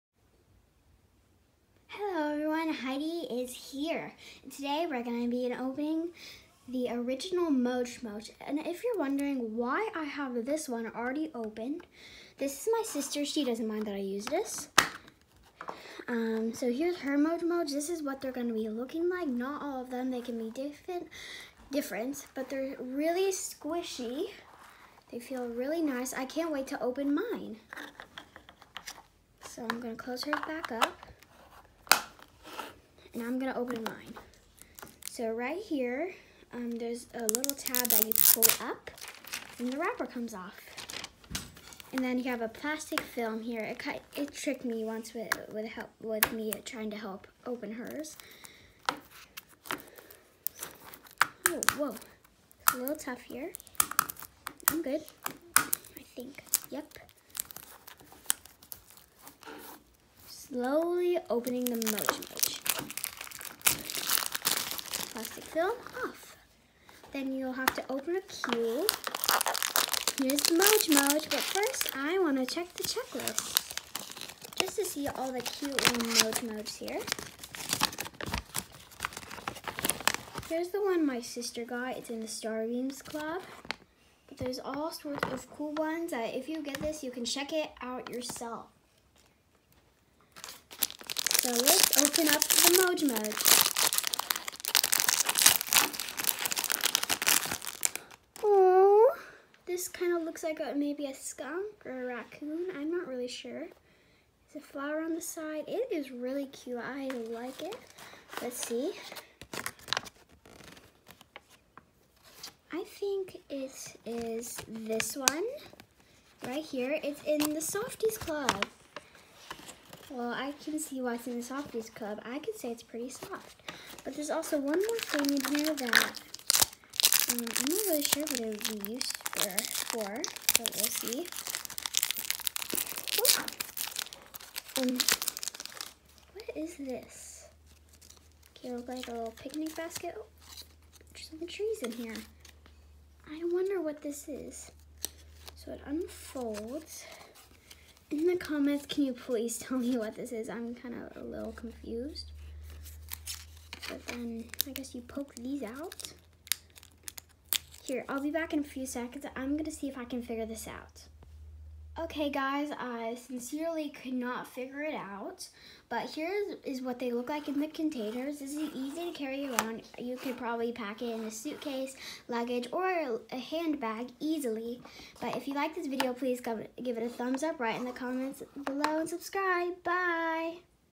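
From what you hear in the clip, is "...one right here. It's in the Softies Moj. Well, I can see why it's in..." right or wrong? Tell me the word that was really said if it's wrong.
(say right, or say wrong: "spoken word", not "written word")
wrong: "Club", not "Moj".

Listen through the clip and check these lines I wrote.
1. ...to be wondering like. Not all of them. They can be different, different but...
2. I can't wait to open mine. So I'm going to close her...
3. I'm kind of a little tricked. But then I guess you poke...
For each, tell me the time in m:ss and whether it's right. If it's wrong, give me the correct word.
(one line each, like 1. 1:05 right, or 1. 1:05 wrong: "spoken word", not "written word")
1. 0:18 wrong: "looking", not "wondering"
2. 0:26 right
3. 2:30 wrong: "confused", not "tricked".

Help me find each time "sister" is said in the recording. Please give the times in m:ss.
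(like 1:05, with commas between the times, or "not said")
0:12, 1:21.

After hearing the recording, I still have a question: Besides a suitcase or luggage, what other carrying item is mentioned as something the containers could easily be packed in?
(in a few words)
A handbag.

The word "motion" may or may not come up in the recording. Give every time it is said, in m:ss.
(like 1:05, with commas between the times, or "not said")
1:01.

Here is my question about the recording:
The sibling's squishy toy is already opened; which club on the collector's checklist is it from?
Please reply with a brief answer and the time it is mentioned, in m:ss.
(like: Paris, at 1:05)
Starbeams Club, at 1:22.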